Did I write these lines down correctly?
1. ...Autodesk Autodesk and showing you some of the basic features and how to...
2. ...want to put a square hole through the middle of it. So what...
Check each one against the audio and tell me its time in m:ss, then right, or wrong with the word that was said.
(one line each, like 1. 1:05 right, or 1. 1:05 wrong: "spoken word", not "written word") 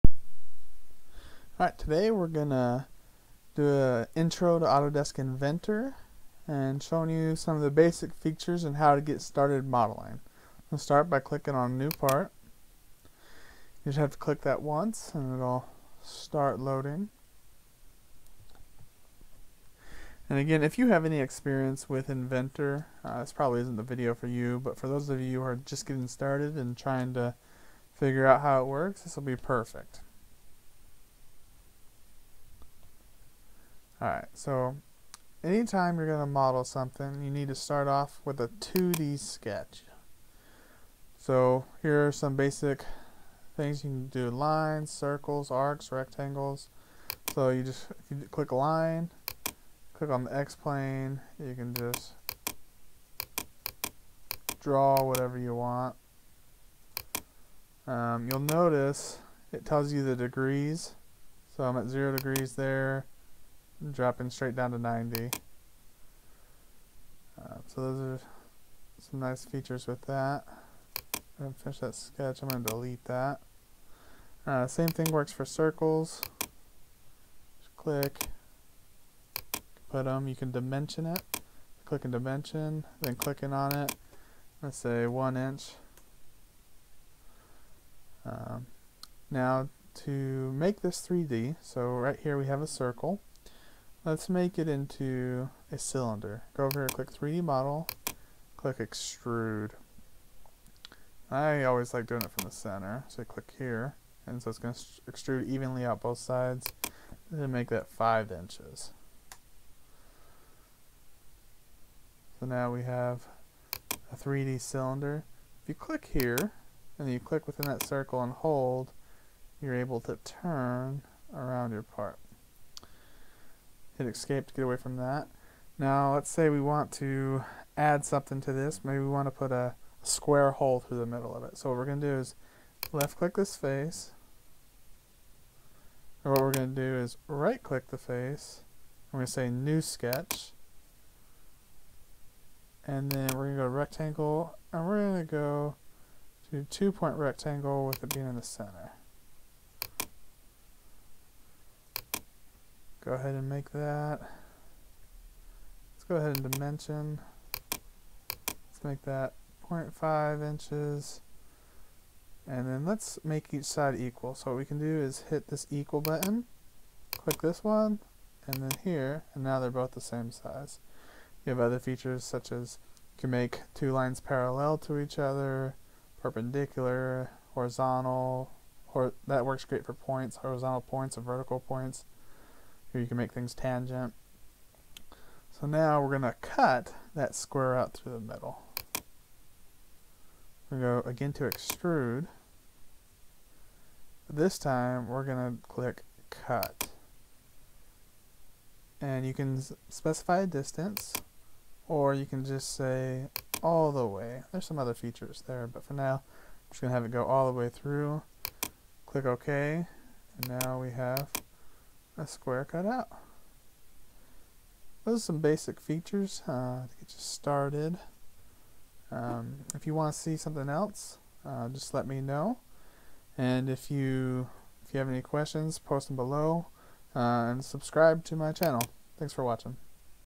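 1. 0:04 wrong: "Inventor", not "Autodesk"
2. 2:09 right.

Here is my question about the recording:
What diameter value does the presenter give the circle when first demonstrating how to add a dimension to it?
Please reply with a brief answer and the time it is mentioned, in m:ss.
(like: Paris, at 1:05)
1 inch, at 1:25.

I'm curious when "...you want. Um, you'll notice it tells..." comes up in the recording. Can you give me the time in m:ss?
0:55.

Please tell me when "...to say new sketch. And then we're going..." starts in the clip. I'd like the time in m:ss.
2:19.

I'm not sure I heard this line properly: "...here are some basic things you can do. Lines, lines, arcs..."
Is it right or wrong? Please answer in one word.
wrong.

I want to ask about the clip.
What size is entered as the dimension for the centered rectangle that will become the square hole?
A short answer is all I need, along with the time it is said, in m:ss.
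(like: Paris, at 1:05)
0.5 inches, at 2:39.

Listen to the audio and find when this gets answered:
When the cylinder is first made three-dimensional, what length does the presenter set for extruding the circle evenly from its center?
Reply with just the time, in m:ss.
1:47.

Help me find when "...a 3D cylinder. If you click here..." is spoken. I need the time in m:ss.
1:54.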